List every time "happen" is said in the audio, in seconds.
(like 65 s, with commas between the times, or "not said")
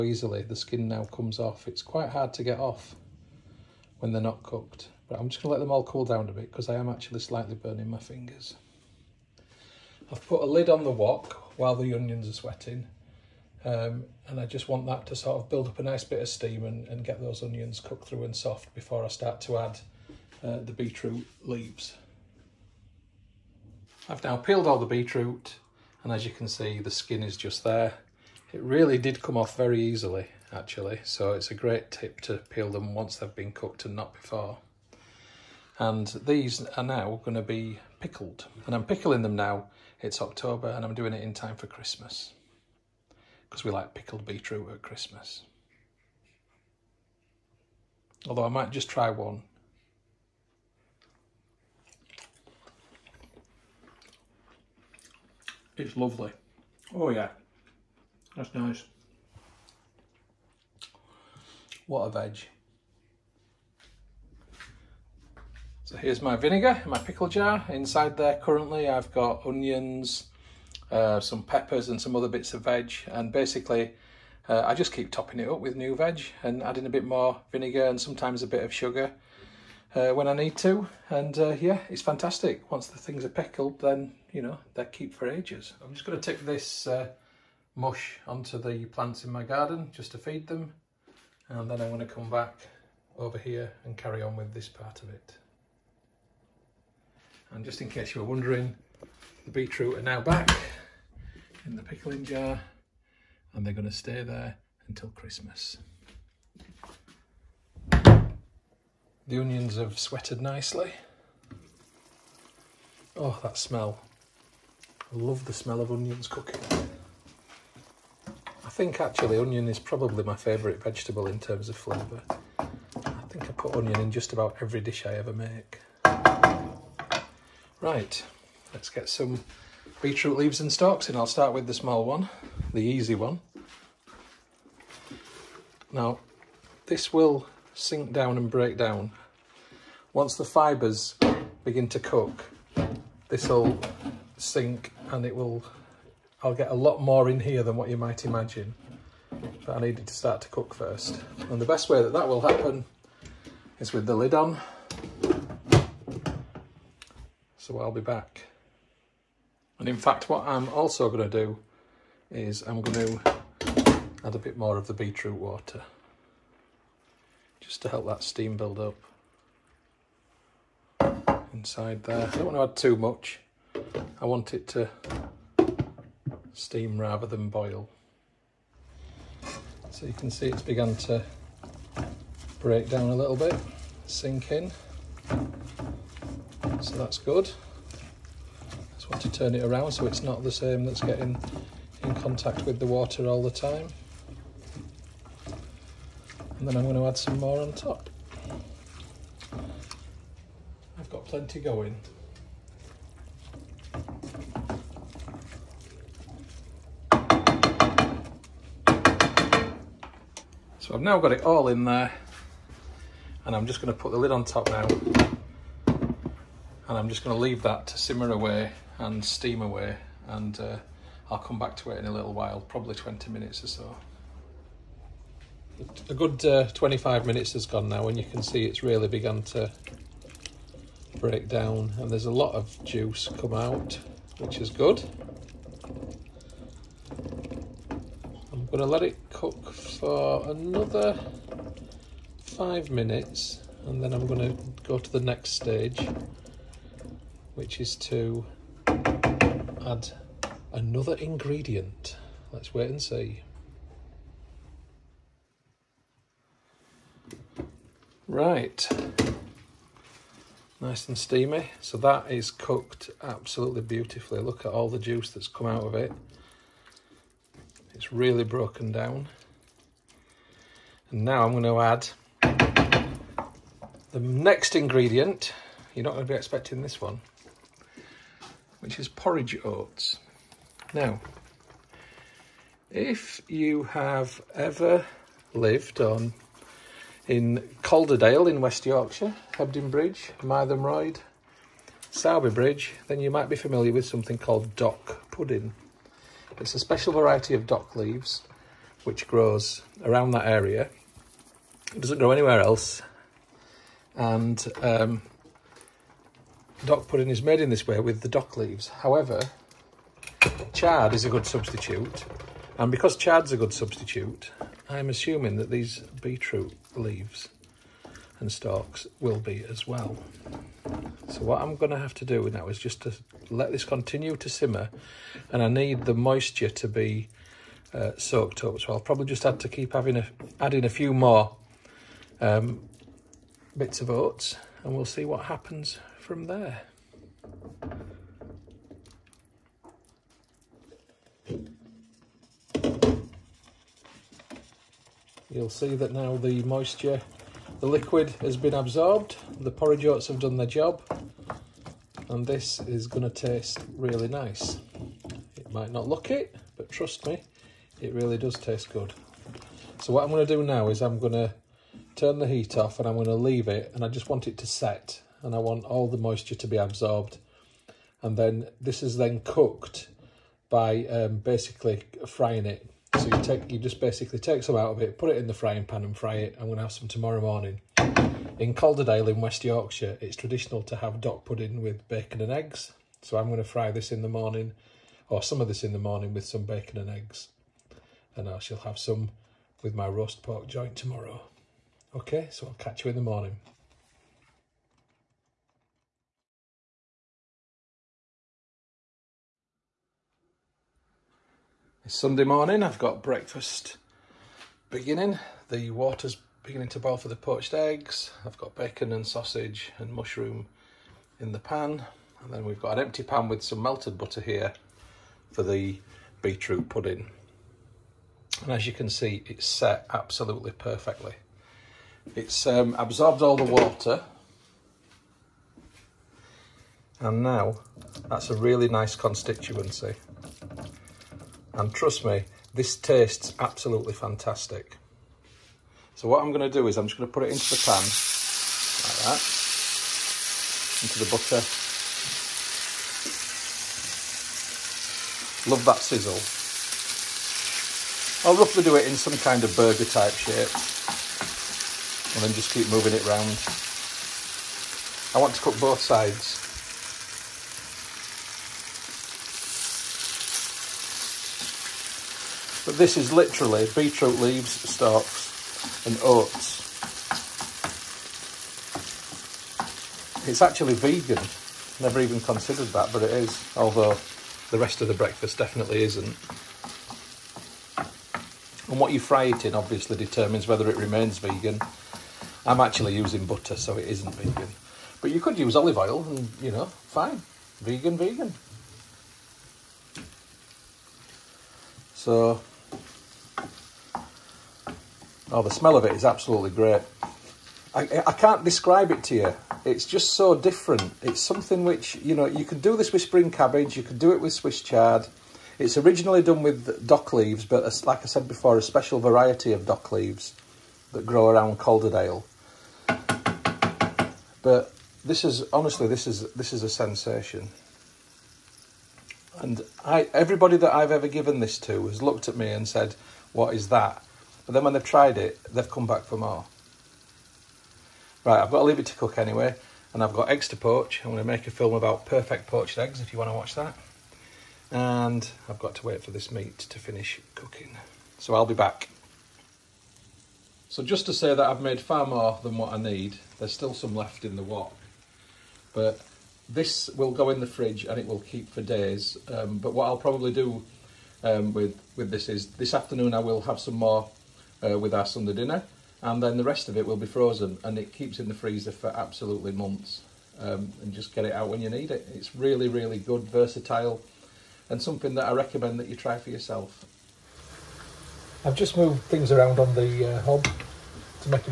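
152 s, 335 s.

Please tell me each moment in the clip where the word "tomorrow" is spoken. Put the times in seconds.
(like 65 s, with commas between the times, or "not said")
377 s, 390 s.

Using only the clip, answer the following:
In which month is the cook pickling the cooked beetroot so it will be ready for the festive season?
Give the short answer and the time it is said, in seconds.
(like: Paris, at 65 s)
October, at 40 s.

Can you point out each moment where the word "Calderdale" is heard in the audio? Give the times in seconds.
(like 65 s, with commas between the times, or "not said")
287 s, 378 s, 511 s.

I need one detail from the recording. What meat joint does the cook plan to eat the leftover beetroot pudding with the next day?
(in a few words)
roast pork.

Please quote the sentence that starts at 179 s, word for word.
So you can see it's begun to break down a little bit, sink in so that's good.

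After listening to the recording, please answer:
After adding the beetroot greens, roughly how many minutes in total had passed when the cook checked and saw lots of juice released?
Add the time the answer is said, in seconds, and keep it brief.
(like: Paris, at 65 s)
25, at 226 s.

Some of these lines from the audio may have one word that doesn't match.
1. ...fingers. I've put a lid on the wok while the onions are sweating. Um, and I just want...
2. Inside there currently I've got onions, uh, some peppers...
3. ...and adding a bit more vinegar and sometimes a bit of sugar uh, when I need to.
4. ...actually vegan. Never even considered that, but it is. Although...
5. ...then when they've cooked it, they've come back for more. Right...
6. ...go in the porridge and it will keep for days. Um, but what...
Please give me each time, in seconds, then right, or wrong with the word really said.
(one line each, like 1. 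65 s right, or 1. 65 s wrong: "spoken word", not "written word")
1. 7 s right
2. 67 s right
3. 76 s right
4. 470 s right
5. 524 s wrong: "tried", not "cooked"
6. 547 s wrong: "fridge", not "porridge".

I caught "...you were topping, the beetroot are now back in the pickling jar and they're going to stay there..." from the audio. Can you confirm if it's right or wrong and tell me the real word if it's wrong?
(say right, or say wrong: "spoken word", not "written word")
wrong: "wondering", not "topping".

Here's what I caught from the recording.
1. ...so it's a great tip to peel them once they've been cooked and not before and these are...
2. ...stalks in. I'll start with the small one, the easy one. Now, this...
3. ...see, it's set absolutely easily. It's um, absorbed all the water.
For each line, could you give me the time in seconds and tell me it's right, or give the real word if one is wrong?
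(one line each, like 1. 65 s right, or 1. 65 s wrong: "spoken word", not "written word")
1. 31 s right
2. 130 s right
3. 419 s wrong: "perfectly", not "easily".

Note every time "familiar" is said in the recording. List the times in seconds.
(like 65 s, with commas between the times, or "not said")
293 s.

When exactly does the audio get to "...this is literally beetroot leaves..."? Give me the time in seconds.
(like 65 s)
462 s.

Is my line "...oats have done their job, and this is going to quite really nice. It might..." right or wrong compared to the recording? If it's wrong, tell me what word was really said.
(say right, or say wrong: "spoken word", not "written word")
wrong: "taste", not "quite".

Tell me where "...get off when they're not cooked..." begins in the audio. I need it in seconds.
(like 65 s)
2 s.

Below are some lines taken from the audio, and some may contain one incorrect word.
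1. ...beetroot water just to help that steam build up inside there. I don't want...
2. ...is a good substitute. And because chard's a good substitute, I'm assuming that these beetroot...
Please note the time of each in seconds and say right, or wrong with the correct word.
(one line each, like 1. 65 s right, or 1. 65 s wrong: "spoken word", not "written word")
1. 164 s right
2. 311 s right.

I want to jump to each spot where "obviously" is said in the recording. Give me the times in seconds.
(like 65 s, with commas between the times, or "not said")
479 s.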